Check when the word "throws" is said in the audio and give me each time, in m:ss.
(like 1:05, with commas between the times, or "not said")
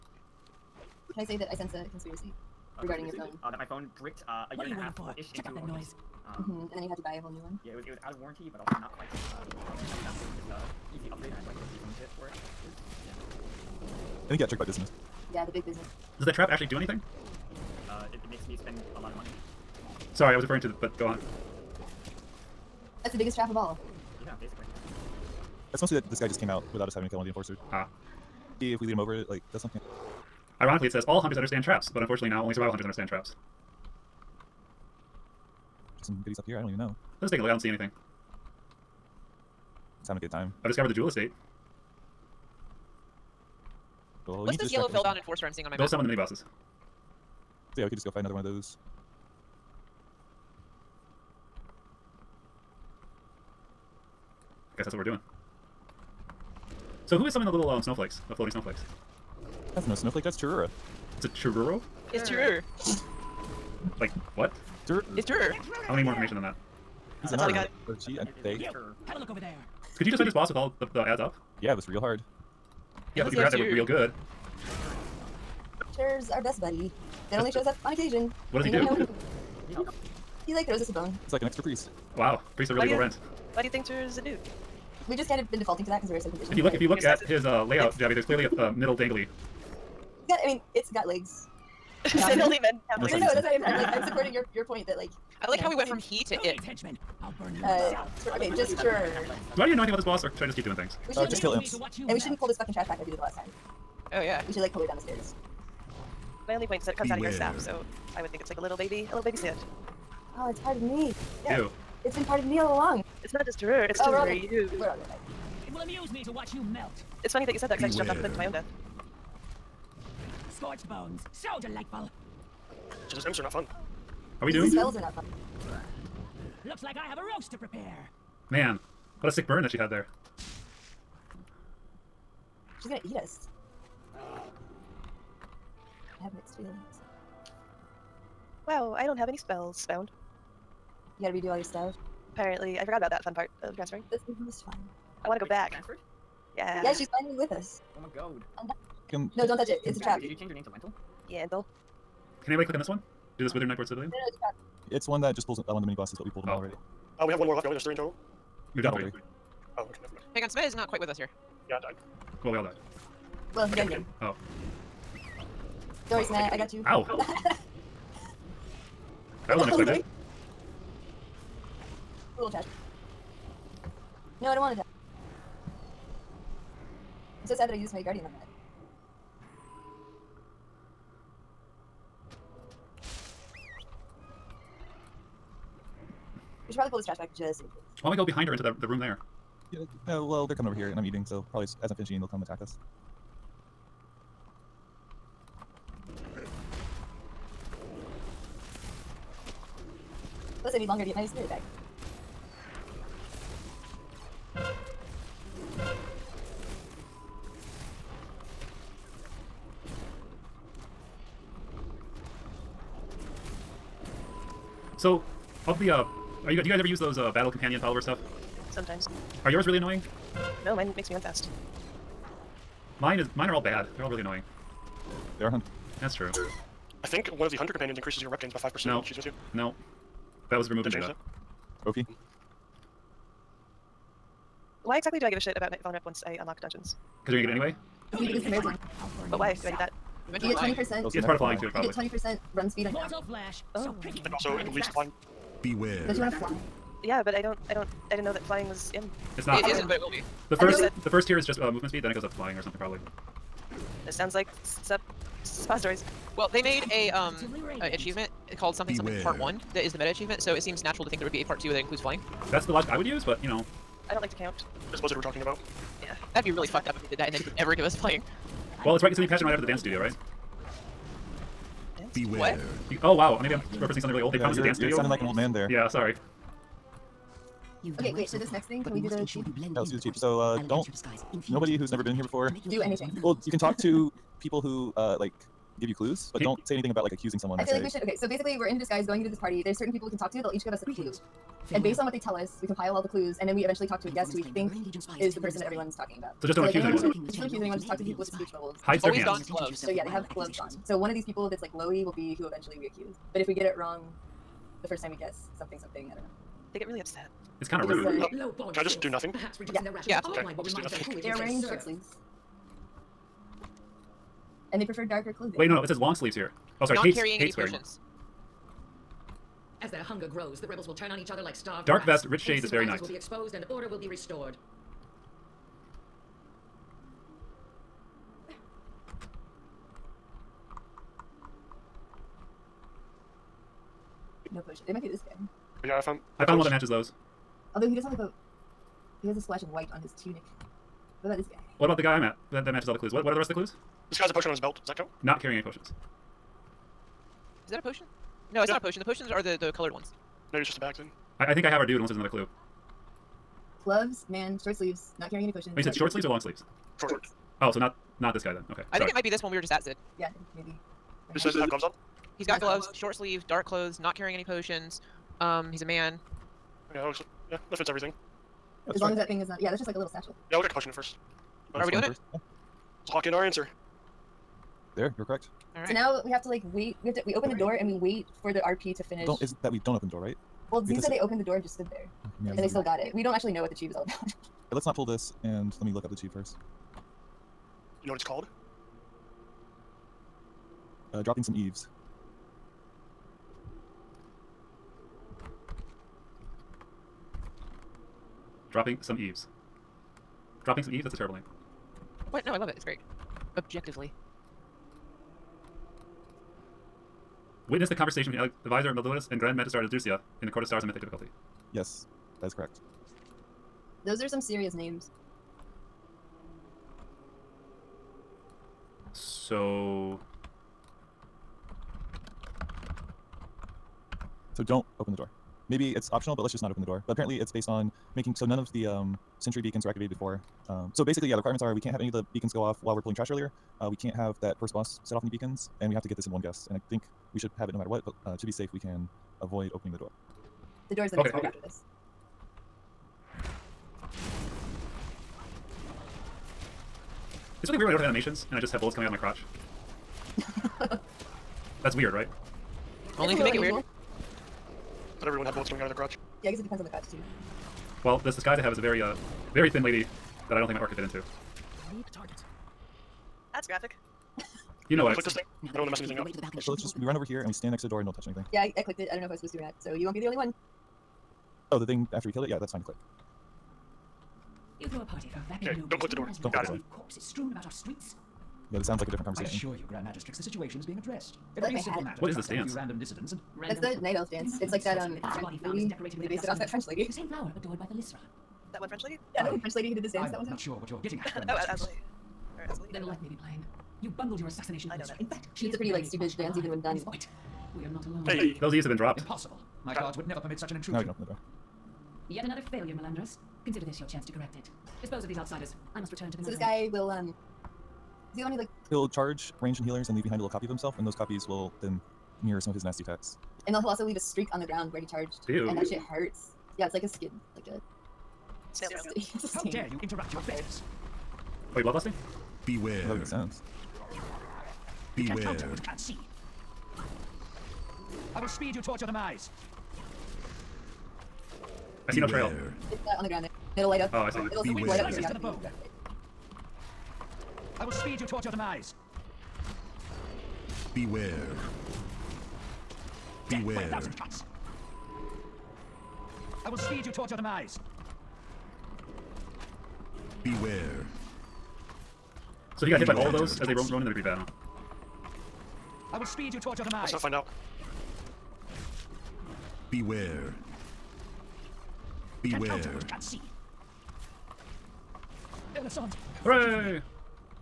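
1:20, 7:54.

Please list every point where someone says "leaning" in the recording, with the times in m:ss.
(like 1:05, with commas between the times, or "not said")
not said.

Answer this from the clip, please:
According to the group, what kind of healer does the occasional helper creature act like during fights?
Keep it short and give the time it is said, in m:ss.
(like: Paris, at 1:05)
an extra priest, at 1:21.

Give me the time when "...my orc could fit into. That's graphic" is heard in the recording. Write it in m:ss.
7:40.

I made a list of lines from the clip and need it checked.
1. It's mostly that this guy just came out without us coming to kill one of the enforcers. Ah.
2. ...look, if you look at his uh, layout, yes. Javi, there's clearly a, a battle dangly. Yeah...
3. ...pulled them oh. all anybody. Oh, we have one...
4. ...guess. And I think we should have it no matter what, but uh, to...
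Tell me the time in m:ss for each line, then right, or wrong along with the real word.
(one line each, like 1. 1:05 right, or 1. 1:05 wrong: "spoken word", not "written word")
1. 0:25 wrong: "having", not "coming"
2. 1:26 wrong: "middle", not "battle"
3. 2:36 wrong: "already", not "anybody"
4. 7:16 right.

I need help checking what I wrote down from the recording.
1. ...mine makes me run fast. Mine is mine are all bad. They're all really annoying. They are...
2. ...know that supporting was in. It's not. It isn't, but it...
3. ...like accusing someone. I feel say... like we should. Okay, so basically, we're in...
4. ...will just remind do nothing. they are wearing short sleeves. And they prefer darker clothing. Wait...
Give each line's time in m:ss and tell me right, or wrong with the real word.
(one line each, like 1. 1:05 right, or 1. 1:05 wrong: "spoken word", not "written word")
1. 3:40 right
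2. 4:08 wrong: "flying", not "supporting"
3. 4:47 right
4. 5:10 right.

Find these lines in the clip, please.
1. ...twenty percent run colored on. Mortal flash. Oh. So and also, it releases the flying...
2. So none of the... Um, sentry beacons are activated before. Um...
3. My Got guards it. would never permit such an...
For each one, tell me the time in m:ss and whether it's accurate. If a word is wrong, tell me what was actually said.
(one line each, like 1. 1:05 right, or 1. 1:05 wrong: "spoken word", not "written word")
1. 4:01 wrong: "speed", not "colored"
2. 7:08 right
3. 8:19 right.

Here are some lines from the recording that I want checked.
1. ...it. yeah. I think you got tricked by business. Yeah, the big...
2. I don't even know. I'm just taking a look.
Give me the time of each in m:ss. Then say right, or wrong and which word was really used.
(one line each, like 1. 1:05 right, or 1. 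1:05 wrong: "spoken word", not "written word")
1. 0:12 right
2. 0:36 right.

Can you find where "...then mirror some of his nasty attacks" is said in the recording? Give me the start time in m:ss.
8:31.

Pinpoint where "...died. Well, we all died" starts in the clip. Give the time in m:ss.
2:41.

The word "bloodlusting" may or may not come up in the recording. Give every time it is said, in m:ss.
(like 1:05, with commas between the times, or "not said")
8:41.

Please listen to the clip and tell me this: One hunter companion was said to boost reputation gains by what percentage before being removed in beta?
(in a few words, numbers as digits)
5%.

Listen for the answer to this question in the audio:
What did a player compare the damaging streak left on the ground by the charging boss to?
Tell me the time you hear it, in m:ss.
8:38.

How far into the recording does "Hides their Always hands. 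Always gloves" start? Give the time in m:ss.
4:58.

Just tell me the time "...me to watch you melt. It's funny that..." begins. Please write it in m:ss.
1:56.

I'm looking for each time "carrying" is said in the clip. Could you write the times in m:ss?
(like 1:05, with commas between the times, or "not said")
5:17, 5:45, 5:55, 6:04.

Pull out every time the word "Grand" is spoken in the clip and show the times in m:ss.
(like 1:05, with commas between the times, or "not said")
6:49, 7:59.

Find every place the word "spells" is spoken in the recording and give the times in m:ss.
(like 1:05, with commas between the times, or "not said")
2:04, 2:19.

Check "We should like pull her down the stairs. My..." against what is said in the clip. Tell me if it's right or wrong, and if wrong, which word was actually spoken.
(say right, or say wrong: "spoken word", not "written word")
right.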